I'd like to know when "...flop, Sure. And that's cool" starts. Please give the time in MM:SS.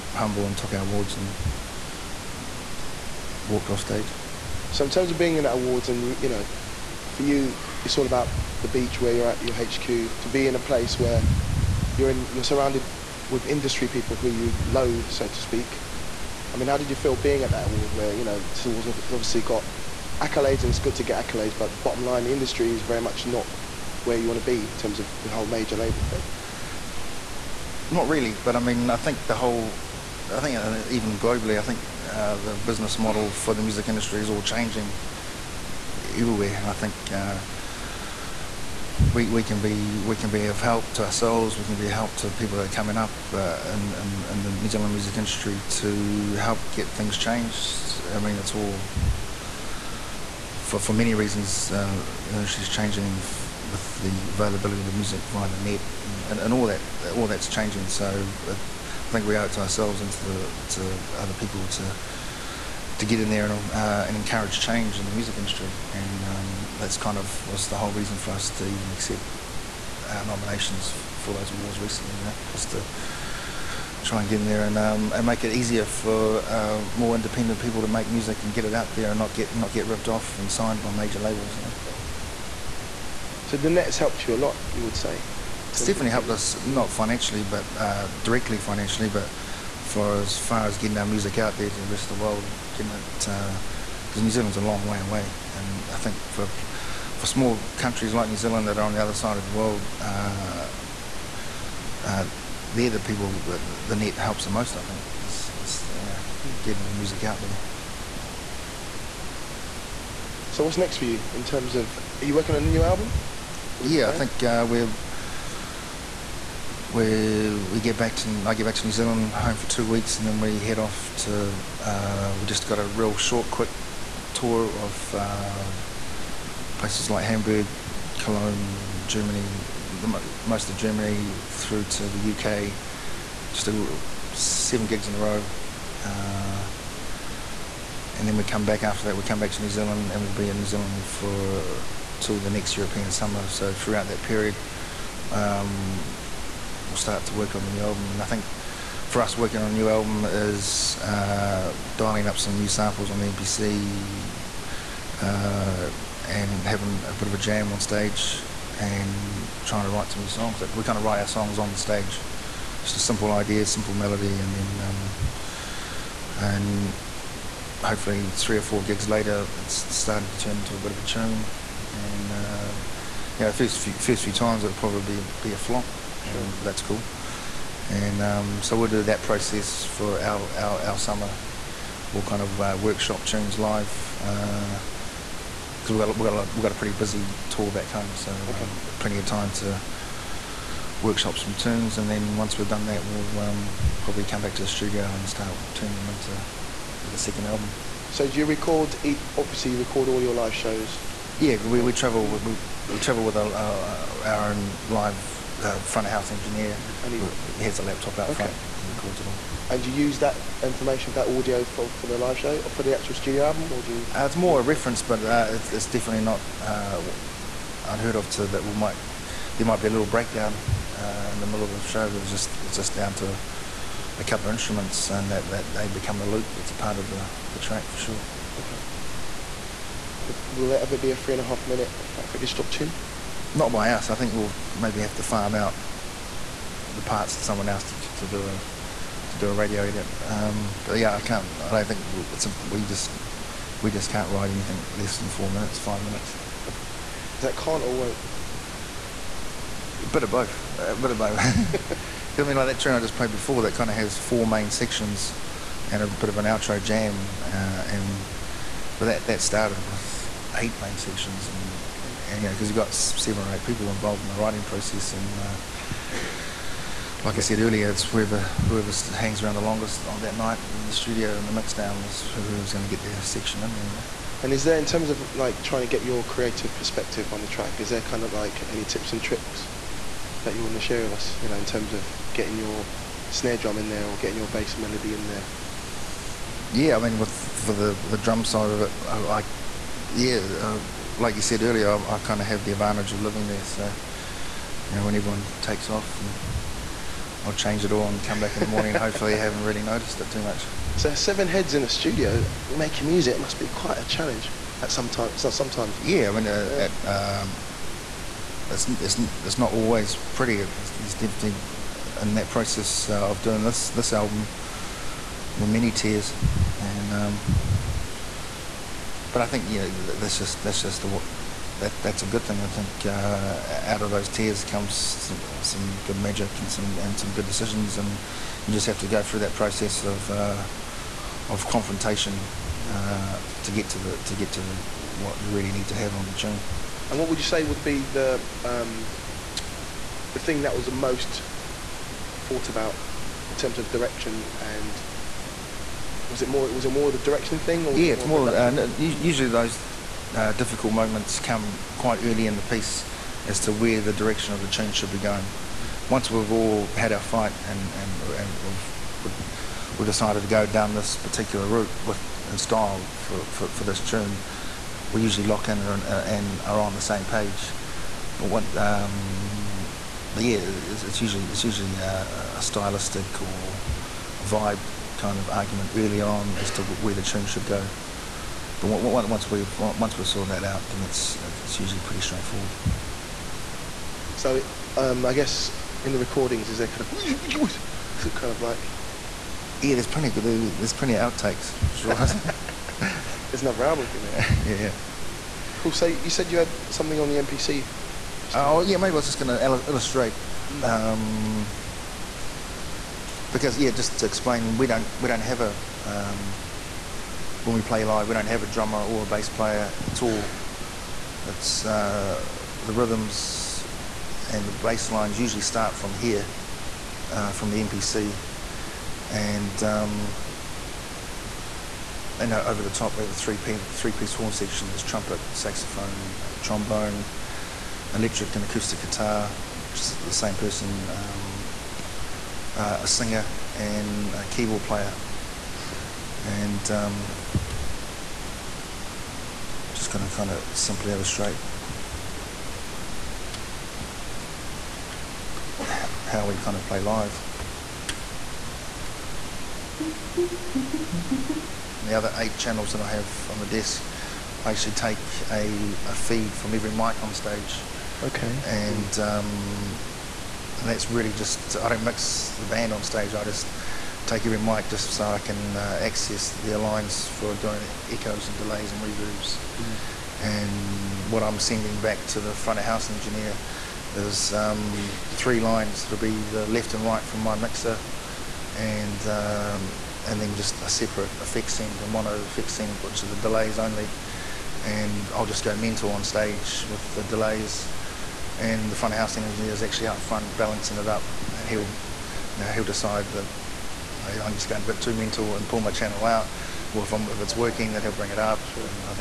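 02:55.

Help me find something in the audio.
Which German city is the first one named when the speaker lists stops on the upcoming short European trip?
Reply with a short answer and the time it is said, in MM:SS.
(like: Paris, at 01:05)
Hamburg, at 02:07.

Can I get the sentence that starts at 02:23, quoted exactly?
So throughout that period, um, we'll start to work on the new album.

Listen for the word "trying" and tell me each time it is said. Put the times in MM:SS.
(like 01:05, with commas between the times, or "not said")
02:39, 04:35.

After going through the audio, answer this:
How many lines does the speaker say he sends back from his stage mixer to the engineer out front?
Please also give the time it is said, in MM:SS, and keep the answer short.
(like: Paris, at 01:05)
3, at 07:55.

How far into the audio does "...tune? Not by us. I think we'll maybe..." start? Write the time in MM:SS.
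03:52.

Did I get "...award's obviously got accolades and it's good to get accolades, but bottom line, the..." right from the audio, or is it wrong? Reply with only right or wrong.
right.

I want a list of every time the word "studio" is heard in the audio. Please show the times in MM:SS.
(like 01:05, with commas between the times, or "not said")
03:14, 03:33, 04:30, 05:01.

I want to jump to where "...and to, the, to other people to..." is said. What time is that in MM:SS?
01:00.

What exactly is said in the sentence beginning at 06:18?
But once we've once we've sorted that out, then it's it's usually pretty straightforward.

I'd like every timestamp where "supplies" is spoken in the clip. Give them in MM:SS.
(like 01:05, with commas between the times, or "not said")
not said.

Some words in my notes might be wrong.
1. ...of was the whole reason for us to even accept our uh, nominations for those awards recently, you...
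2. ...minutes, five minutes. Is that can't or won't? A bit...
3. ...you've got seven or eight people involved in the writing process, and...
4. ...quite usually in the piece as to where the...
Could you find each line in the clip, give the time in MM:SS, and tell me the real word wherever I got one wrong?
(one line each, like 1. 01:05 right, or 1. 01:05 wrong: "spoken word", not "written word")
1. 01:07 right
2. 04:05 right
3. 04:22 right
4. 05:51 wrong: "early", not "usually".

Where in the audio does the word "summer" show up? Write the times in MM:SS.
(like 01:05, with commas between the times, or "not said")
02:23, 03:00.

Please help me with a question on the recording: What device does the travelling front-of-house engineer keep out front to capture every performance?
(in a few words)
laptop.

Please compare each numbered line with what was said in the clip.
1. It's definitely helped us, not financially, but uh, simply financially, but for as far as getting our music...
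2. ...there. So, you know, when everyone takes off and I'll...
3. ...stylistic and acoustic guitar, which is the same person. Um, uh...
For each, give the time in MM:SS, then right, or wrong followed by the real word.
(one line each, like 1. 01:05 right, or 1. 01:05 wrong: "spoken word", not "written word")
1. 01:25 wrong: "directly", not "simply"
2. 04:53 right
3. 07:08 wrong: "electric", not "stylistic".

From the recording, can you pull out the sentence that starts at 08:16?
Well, if, if, it's working, then he'll bring it up, sure.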